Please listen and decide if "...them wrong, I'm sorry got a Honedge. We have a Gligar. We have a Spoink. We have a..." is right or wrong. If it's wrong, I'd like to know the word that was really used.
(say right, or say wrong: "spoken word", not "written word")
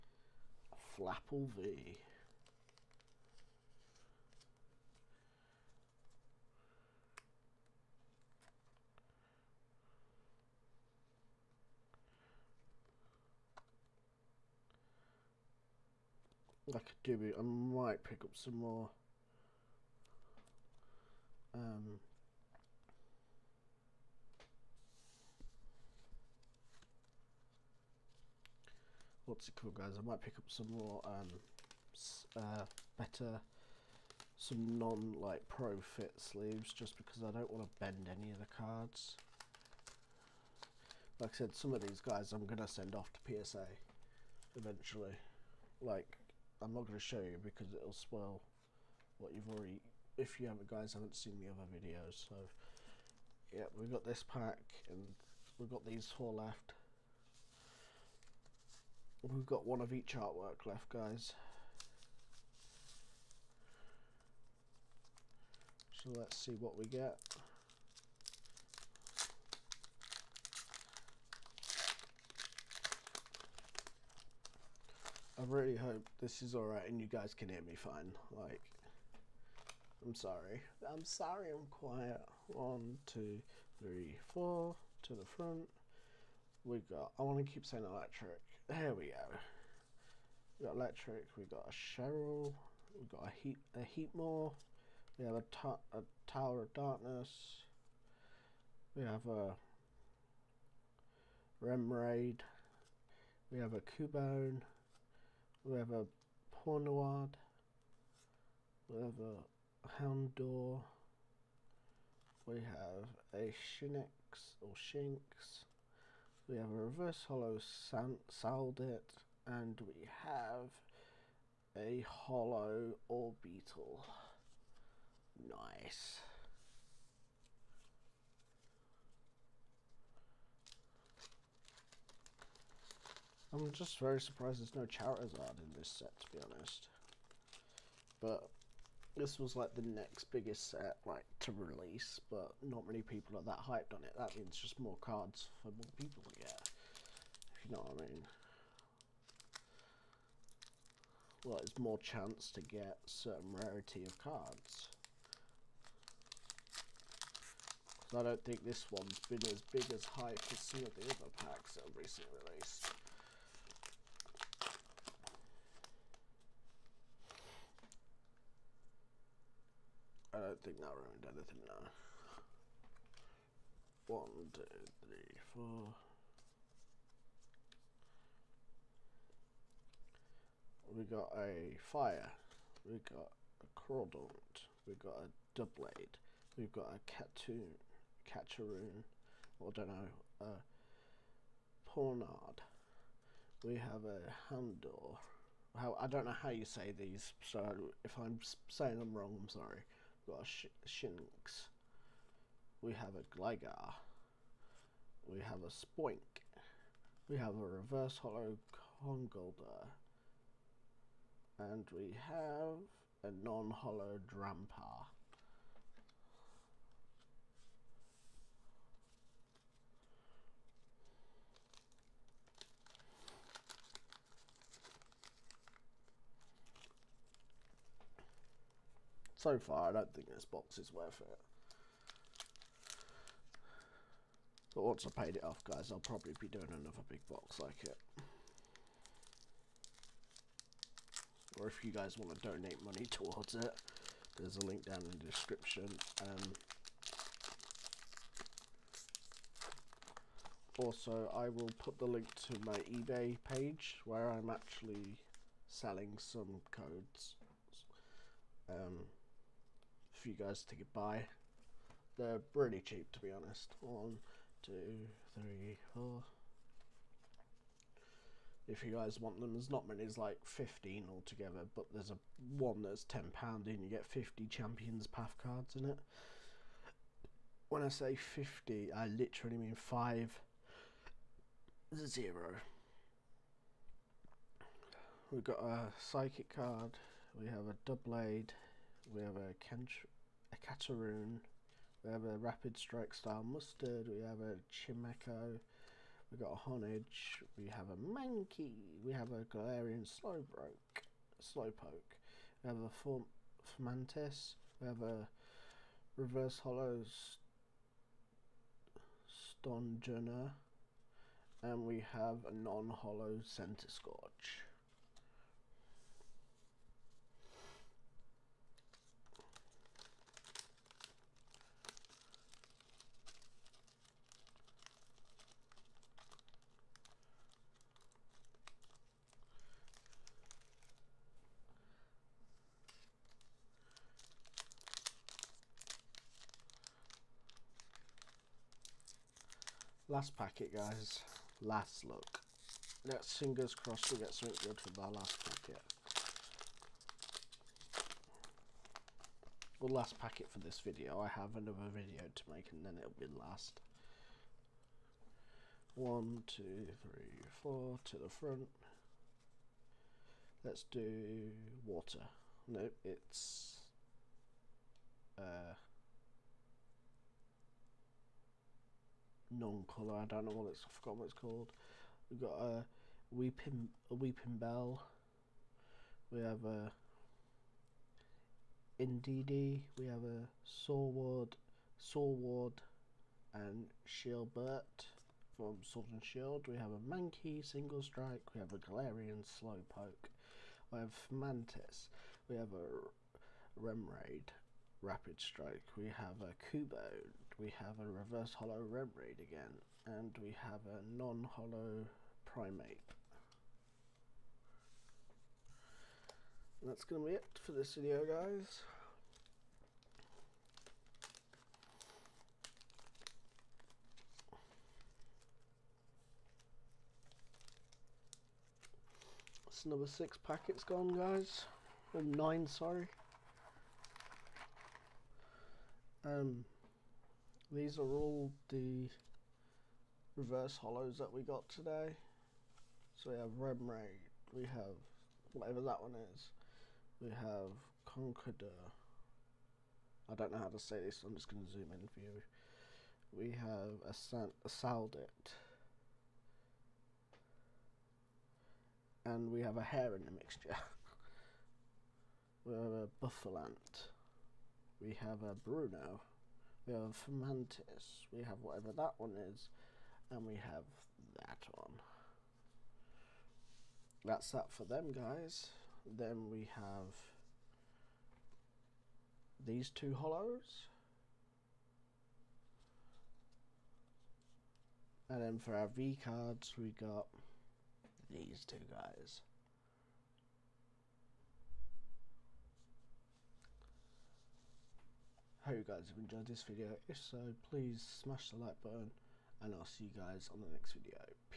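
wrong: "Shinx", not "Honedge".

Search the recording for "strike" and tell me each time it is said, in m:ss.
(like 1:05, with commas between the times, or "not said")
4:52, 6:28, 6:35.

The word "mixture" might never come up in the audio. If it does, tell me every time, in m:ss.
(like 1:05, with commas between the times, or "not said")
7:30.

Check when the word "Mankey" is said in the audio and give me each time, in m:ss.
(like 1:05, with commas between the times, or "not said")
4:57, 6:27.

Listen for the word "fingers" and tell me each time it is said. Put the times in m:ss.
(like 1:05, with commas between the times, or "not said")
5:43.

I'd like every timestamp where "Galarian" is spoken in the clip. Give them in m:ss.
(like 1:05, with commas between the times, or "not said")
4:59, 6:28.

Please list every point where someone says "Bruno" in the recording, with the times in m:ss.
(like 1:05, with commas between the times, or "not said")
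7:35.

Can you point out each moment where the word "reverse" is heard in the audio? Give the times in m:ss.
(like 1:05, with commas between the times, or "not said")
1:56, 3:27, 5:06, 6:38, 7:10.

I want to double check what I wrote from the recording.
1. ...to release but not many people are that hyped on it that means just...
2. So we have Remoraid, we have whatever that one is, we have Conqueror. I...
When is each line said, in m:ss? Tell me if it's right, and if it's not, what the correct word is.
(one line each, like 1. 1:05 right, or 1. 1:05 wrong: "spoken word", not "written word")
1. 2:21 right
2. 7:13 right.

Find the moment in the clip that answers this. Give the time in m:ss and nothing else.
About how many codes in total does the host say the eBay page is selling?
4:30.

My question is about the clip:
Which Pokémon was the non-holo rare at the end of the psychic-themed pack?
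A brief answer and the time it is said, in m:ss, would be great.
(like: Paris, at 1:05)
Centiskorch, at 5:12.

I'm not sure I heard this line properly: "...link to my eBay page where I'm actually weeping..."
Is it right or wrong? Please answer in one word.
wrong.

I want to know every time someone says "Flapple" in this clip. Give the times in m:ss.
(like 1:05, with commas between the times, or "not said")
0:00.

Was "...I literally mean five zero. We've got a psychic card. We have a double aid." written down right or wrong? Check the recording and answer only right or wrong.
right.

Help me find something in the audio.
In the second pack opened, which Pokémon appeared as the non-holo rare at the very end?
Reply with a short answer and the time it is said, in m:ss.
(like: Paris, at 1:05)
Drampa, at 3:33.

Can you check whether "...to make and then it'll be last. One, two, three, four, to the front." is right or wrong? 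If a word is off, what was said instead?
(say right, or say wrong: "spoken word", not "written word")
right.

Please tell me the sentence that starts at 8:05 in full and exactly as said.
hope you guys have enjoyed this video.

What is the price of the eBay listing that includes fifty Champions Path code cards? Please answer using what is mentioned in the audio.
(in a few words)
10 pounds.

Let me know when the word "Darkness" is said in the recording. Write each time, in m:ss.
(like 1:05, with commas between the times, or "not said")
1:36.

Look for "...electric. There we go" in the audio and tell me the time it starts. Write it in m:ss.
1:27.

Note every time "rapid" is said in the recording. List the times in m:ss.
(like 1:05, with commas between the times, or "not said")
4:52, 6:35.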